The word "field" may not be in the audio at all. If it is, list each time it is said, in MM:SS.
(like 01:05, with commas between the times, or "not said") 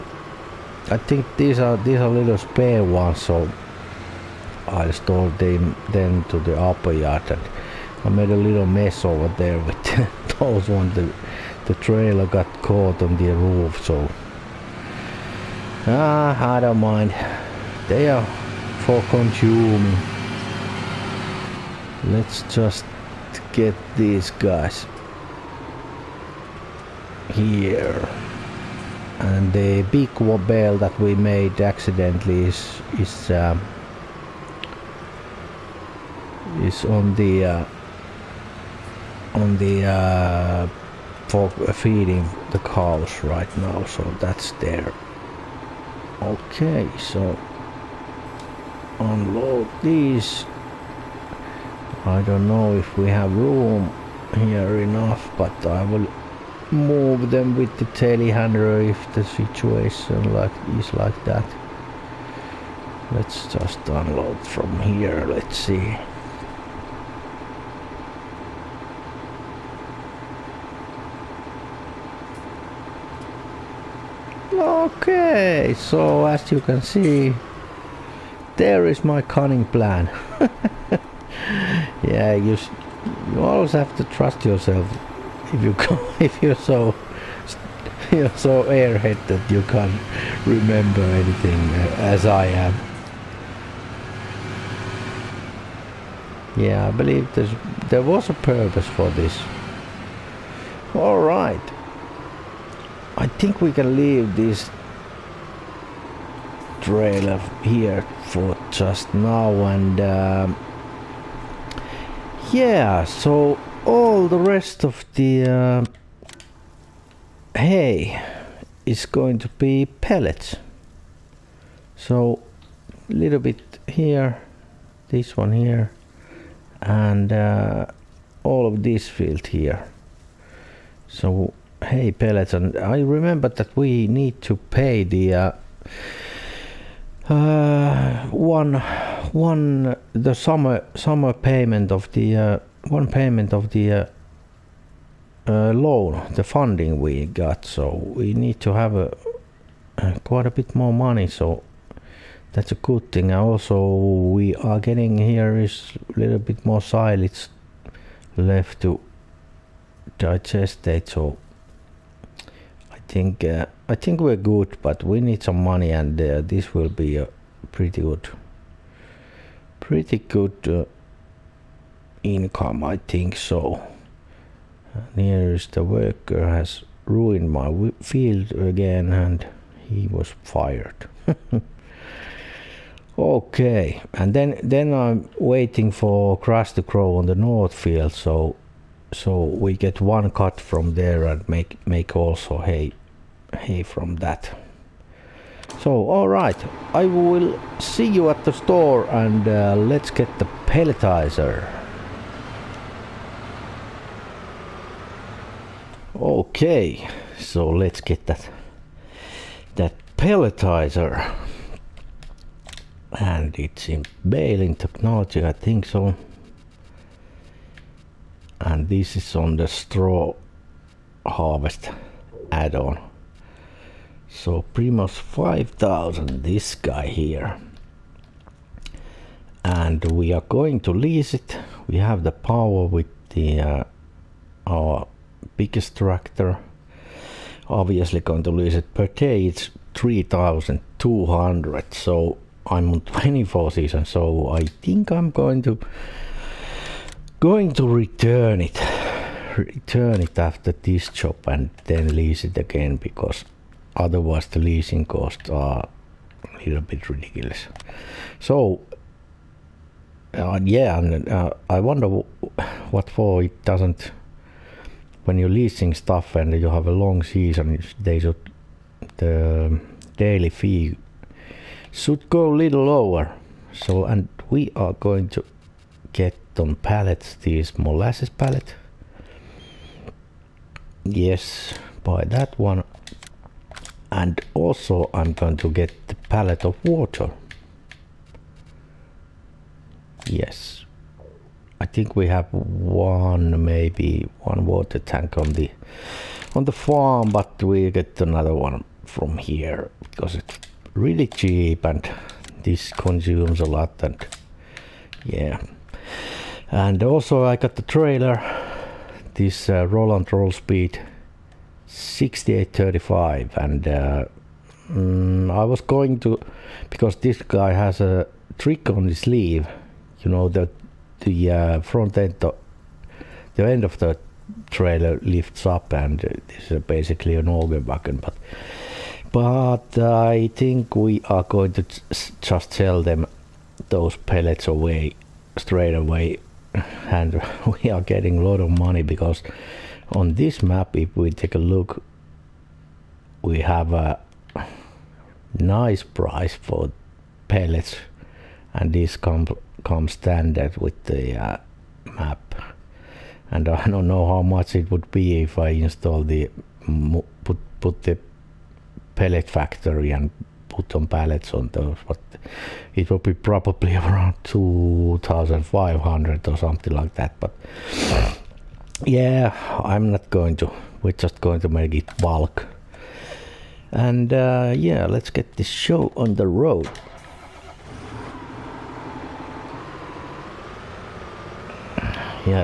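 02:09, 02:58, 03:07.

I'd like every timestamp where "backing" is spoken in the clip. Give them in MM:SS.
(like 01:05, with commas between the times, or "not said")
not said.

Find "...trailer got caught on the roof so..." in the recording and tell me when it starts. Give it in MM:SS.
00:11.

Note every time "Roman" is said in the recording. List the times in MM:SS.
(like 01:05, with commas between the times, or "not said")
not said.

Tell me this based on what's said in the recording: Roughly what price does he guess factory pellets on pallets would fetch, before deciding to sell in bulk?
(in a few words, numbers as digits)
2,500.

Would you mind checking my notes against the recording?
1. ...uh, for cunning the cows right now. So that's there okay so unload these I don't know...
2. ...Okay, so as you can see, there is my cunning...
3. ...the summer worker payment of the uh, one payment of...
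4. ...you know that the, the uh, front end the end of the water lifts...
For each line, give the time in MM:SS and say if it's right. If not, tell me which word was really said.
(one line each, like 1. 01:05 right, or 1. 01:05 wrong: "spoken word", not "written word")
1. 00:39 wrong: "feeding", not "cunning"
2. 01:14 right
3. 02:20 wrong: "summer", not "worker"
4. 05:20 wrong: "trailer", not "water".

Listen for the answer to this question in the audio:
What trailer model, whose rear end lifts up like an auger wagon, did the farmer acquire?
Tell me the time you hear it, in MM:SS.
05:09.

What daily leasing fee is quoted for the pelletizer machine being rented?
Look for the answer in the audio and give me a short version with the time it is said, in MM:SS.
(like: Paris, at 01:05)
3200, at 03:59.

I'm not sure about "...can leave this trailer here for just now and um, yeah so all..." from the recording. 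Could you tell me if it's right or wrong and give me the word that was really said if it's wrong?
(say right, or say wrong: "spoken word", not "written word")
right.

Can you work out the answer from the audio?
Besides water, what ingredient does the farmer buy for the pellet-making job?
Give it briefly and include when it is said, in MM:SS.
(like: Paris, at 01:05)
molasses, at 04:37.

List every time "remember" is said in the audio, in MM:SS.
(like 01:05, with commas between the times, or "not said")
01:30, 02:12.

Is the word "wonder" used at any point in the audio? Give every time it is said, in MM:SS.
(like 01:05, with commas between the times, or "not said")
04:21.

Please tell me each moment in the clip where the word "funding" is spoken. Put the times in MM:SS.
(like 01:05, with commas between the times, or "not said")
02:26.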